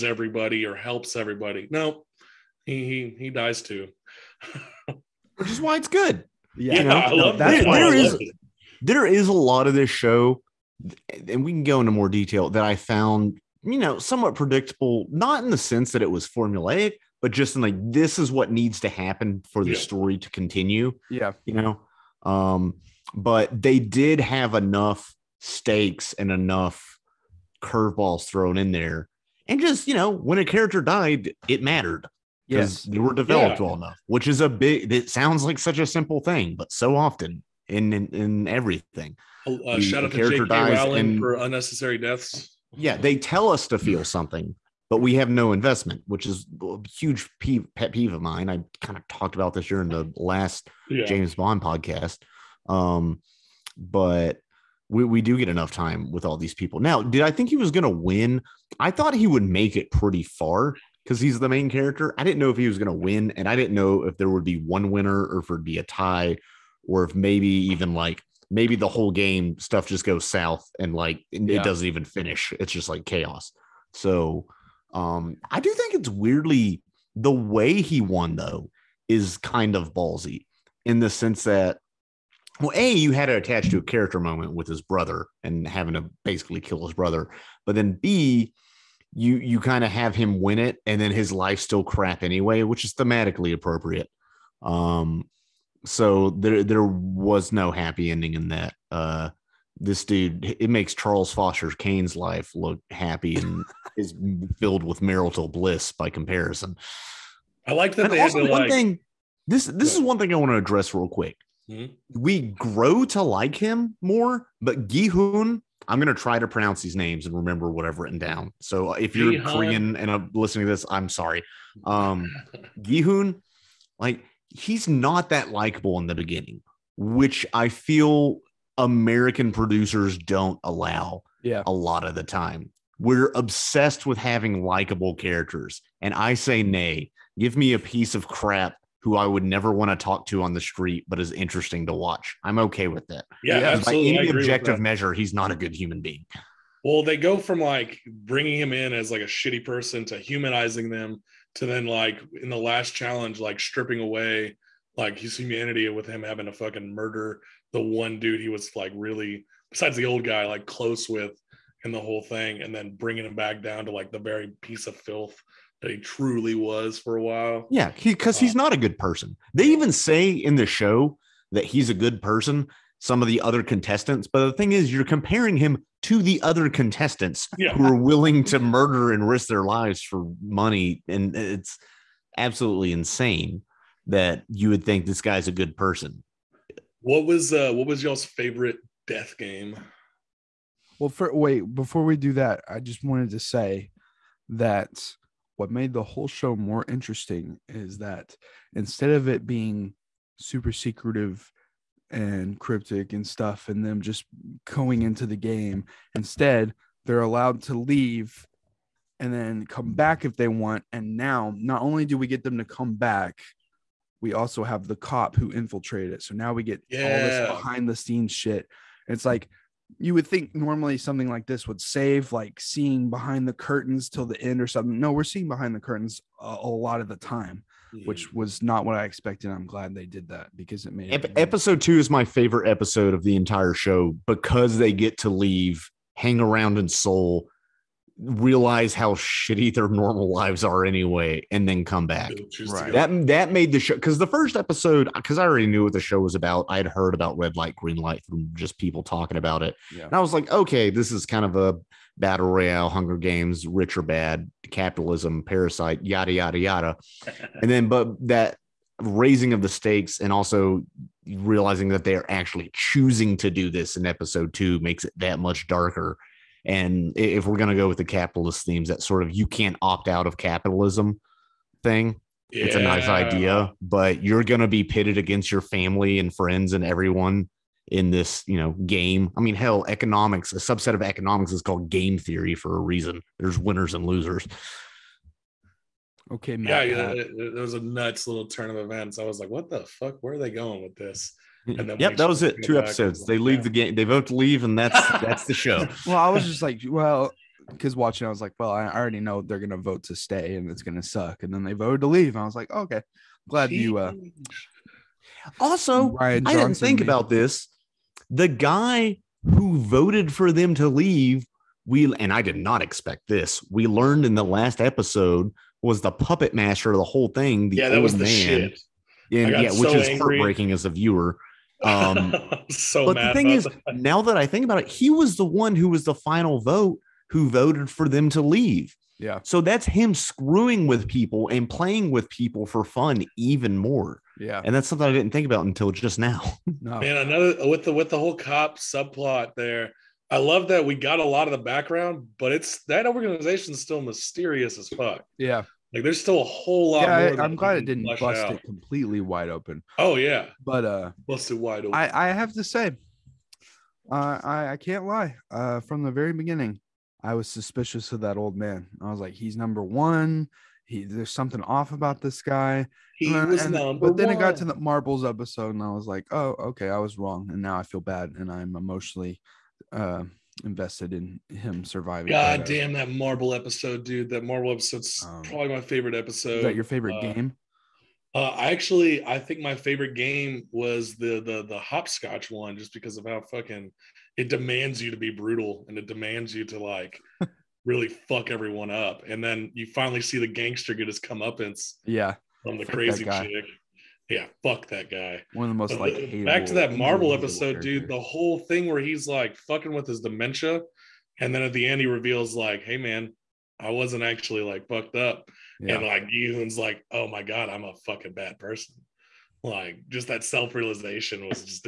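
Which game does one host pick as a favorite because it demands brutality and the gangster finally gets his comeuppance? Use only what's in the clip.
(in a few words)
hopscotch.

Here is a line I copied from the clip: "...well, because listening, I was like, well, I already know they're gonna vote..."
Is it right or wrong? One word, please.
wrong.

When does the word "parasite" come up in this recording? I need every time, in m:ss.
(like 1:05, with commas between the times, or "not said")
4:15.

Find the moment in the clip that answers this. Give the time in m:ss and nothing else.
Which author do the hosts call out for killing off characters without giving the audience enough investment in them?
0:40.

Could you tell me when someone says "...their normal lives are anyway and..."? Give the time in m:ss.
3:59.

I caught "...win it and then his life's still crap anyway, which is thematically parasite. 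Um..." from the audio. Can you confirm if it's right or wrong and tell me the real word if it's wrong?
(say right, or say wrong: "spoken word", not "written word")
wrong: "appropriate", not "parasite".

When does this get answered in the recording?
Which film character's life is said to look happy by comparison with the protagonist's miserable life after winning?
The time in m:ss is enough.
1:40.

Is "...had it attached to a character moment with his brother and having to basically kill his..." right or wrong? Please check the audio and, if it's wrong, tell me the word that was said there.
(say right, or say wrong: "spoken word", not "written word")
right.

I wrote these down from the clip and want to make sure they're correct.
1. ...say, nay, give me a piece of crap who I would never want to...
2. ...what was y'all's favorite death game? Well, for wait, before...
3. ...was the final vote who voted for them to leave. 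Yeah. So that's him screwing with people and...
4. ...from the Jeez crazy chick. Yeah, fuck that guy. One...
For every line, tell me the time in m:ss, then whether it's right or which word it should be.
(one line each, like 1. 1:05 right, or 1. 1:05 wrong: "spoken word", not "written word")
1. 2:16 right
2. 3:07 right
3. 5:25 right
4. 6:32 wrong: "Fuck", not "Jeez".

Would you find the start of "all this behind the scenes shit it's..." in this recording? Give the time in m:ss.
3:37.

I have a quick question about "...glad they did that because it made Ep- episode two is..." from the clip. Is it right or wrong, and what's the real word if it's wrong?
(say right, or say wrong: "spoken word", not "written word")
right.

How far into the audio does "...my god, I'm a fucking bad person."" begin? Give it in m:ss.
6:47.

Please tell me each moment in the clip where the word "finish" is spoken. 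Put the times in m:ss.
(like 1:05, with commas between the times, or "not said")
1:12.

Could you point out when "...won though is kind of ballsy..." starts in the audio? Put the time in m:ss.
1:17.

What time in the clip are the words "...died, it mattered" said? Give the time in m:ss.
0:30.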